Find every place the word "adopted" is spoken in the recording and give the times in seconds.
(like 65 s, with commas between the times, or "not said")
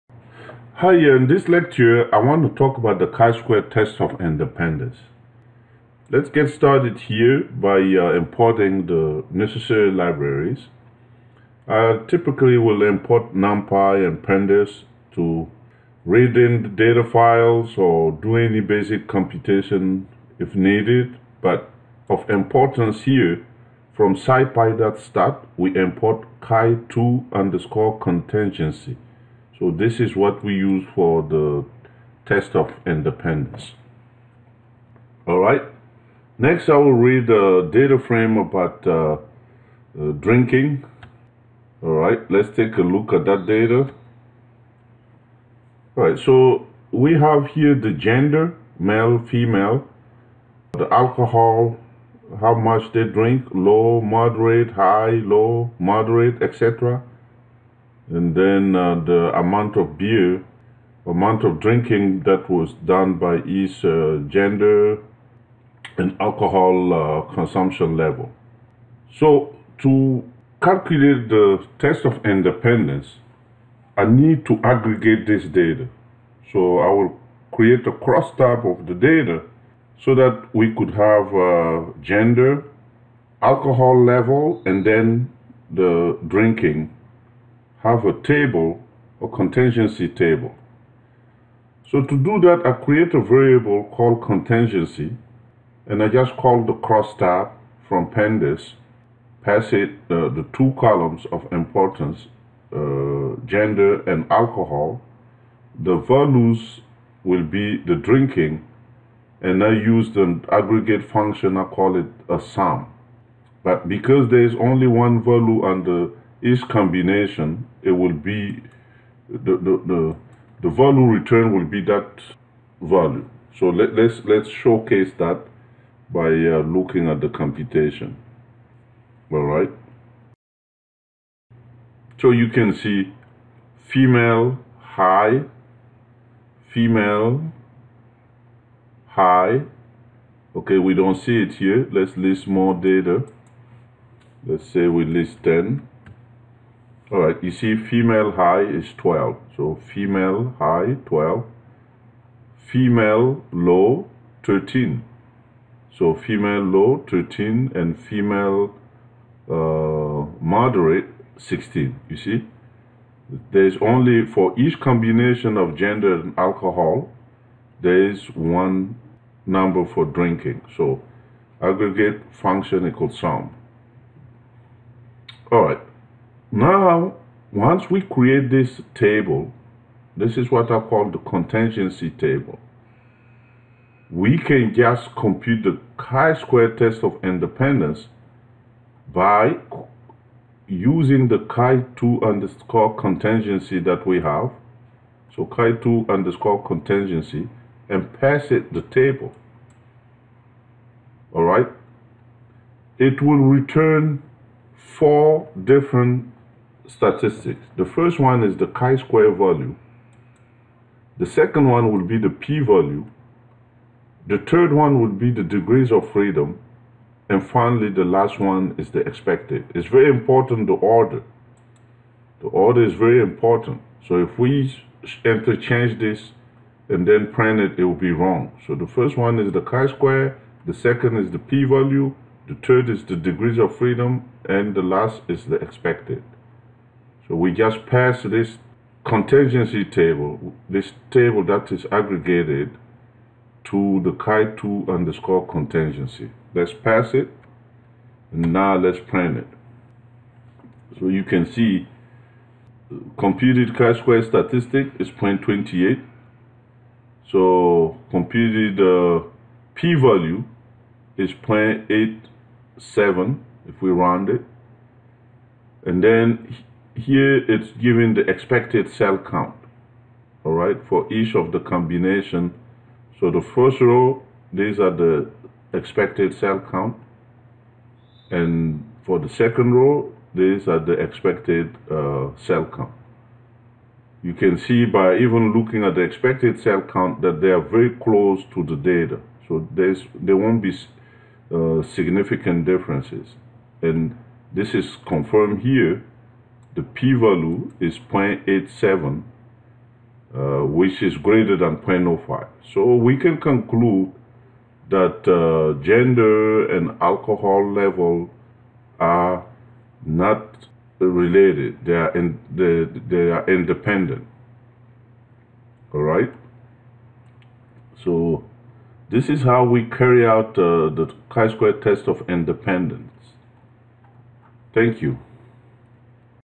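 not said.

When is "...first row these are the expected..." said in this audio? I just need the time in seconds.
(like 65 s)
273 s.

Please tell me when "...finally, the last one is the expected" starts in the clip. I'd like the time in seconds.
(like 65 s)
217 s.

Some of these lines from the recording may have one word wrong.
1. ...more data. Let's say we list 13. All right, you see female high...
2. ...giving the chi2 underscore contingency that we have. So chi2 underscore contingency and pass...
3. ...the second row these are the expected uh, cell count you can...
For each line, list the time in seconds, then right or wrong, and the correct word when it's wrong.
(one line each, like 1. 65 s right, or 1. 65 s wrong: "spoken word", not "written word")
1. 142 s wrong: "10", not "13"
2. 190 s wrong: "using", not "giving"
3. 279 s right.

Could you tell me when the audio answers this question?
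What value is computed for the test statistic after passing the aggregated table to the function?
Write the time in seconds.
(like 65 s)
255 s.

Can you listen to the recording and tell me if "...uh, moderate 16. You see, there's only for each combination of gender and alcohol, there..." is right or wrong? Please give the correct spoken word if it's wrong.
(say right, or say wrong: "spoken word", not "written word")
right.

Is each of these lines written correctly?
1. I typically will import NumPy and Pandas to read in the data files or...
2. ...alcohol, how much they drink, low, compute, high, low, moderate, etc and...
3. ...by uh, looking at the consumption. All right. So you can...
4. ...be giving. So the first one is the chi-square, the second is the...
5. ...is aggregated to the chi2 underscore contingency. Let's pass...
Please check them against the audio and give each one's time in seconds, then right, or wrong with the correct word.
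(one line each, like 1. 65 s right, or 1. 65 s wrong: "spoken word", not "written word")
1. 11 s right
2. 50 s wrong: "moderate", not "compute"
3. 126 s wrong: "computation", not "consumption"
4. 227 s wrong: "wrong", not "giving"
5. 241 s right.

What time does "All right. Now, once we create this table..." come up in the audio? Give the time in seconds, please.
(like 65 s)
175 s.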